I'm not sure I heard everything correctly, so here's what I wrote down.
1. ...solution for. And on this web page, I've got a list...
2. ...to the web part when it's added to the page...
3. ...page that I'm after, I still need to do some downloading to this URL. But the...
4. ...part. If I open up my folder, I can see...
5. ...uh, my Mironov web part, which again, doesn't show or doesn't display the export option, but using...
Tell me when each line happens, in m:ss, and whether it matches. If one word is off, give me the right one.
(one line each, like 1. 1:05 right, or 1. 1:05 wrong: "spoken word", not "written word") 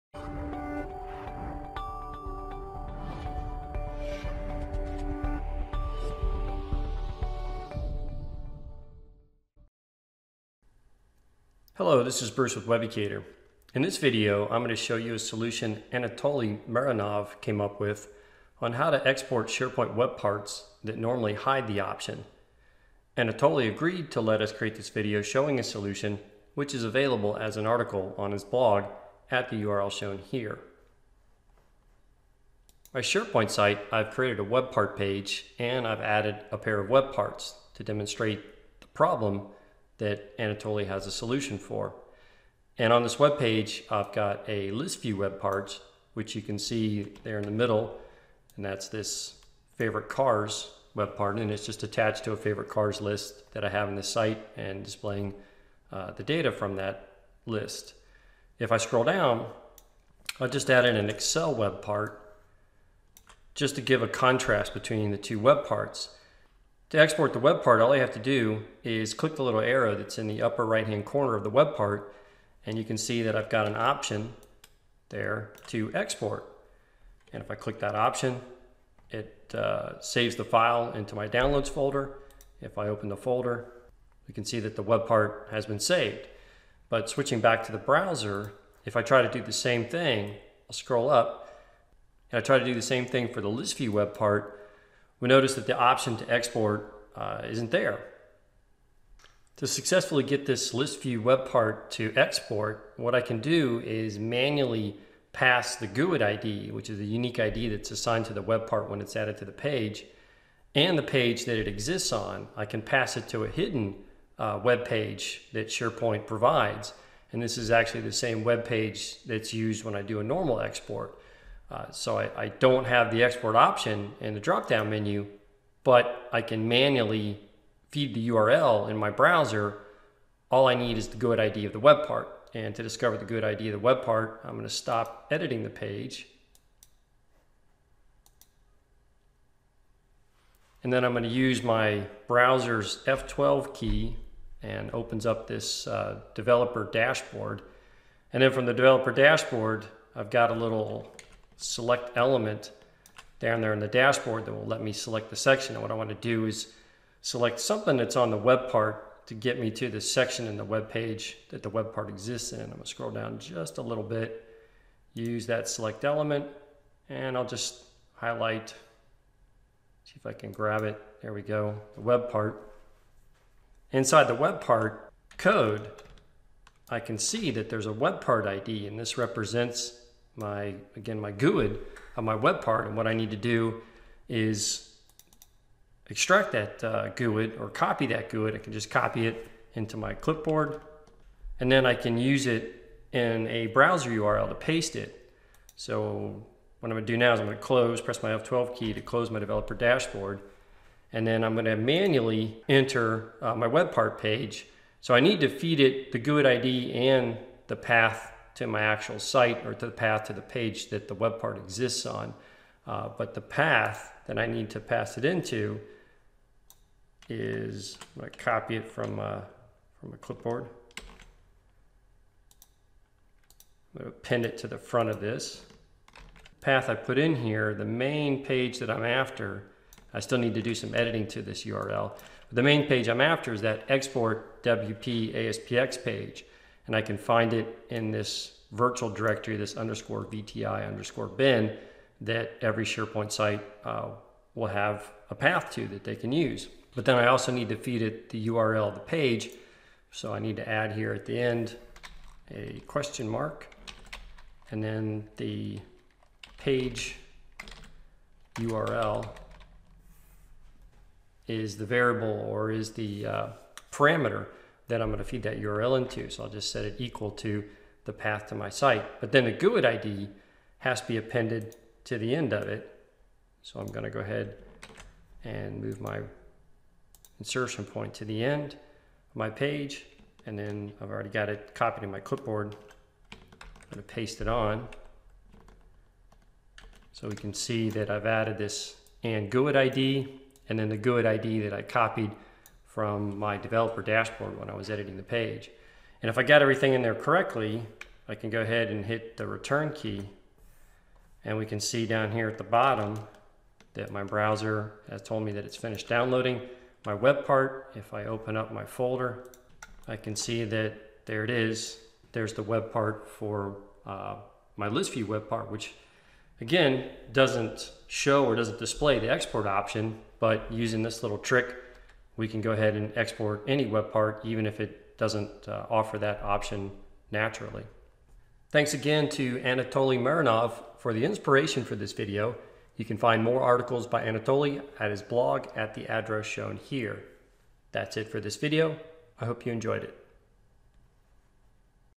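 1. 0:41 right
2. 1:48 right
3. 3:48 wrong: "editing", not "downloading"
4. 5:07 right
5. 5:14 wrong: "ListView", not "Mironov".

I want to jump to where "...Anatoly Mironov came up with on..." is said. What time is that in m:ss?
0:15.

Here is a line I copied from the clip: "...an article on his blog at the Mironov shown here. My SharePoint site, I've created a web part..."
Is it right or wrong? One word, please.
wrong.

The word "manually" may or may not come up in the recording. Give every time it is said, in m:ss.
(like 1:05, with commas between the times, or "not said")
1:44, 2:06, 3:21.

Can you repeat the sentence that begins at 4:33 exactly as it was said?
So I'm going to go ahead and move my insertion point to the end of my page.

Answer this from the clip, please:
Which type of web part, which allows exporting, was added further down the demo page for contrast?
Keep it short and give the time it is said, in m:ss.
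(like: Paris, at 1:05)
Excel web part, at 1:01.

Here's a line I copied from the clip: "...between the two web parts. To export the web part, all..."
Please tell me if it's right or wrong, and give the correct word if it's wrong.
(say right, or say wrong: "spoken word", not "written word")
right.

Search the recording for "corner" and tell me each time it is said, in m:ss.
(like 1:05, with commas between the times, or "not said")
1:11.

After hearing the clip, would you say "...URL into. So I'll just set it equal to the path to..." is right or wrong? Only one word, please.
right.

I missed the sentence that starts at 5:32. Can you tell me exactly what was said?
You can find more articles by Anatoly at his blog at the address shown here.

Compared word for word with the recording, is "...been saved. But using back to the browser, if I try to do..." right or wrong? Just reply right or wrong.
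wrong.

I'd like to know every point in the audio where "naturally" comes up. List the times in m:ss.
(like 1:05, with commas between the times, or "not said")
5:27.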